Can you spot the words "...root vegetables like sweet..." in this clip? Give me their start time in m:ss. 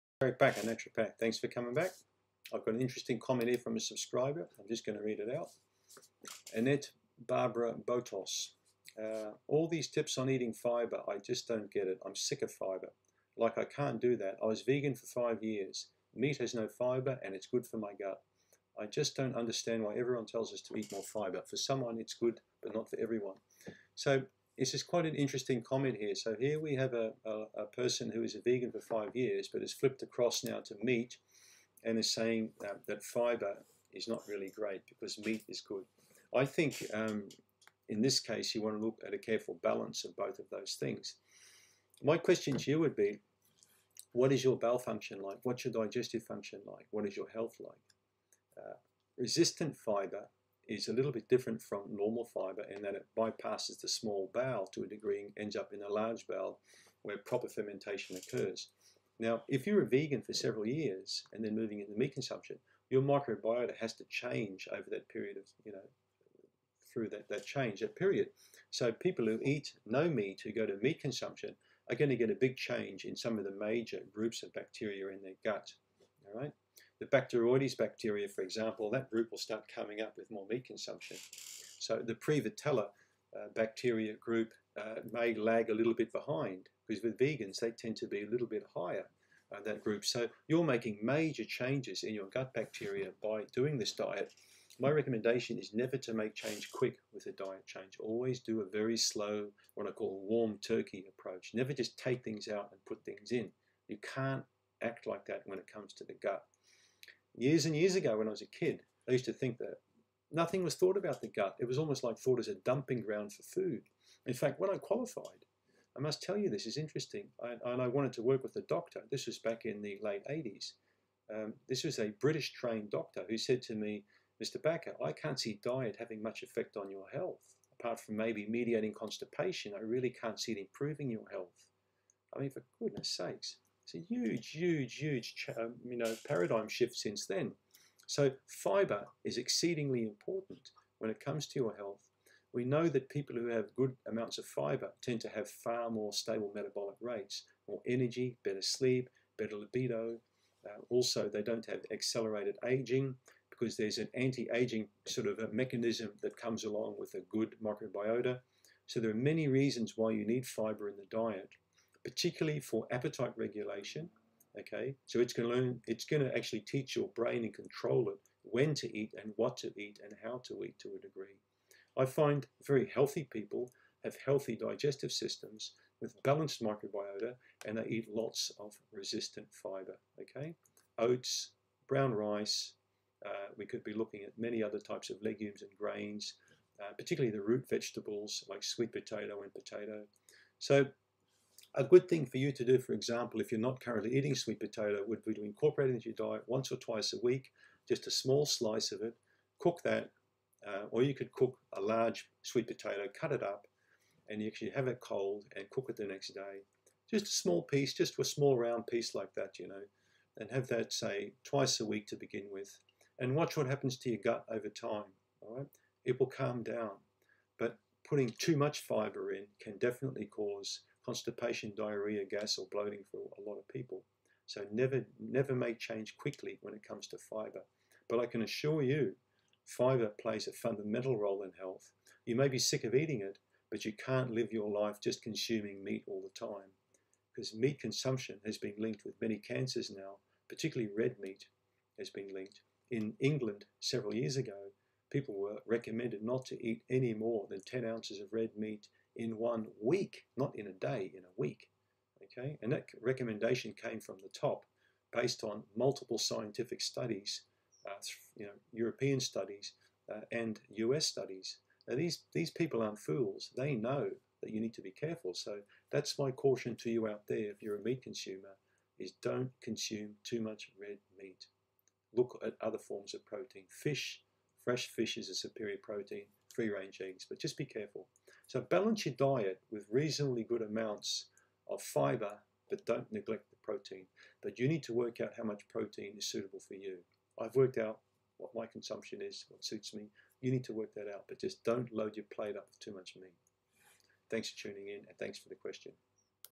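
3:07.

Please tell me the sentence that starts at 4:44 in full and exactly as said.
But you need to work out how much protein is suitable for you.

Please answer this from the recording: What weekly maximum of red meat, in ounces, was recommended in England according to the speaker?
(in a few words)
10 ounces.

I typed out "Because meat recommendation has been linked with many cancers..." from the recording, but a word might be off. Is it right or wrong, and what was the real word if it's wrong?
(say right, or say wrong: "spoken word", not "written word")
wrong: "consumption", not "recommendation".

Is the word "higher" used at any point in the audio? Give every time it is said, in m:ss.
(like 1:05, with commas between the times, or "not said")
1:28.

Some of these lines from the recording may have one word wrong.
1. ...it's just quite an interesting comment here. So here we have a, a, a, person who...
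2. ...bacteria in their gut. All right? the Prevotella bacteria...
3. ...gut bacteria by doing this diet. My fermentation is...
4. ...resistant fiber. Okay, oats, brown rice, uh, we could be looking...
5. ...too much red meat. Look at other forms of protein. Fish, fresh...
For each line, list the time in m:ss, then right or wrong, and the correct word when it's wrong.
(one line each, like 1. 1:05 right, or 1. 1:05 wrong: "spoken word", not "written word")
1. 0:24 right
2. 1:14 wrong: "Bacteroides", not "Prevotella"
3. 1:32 wrong: "recommendation", not "fermentation"
4. 2:58 right
5. 4:30 right.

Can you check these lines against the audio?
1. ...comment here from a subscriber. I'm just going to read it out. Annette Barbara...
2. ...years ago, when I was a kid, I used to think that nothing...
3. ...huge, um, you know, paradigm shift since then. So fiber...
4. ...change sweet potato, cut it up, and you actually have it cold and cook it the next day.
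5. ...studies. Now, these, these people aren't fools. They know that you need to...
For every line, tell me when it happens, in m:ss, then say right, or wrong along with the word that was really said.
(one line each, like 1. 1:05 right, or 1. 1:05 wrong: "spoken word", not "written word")
1. 0:03 right
2. 1:47 right
3. 2:14 right
4. 3:21 wrong: "large", not "change"
5. 4:21 right.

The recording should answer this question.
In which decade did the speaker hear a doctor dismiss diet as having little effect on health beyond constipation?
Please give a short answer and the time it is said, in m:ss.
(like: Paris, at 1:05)
late 80s, at 2:00.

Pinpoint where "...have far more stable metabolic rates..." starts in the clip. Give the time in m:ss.
2:25.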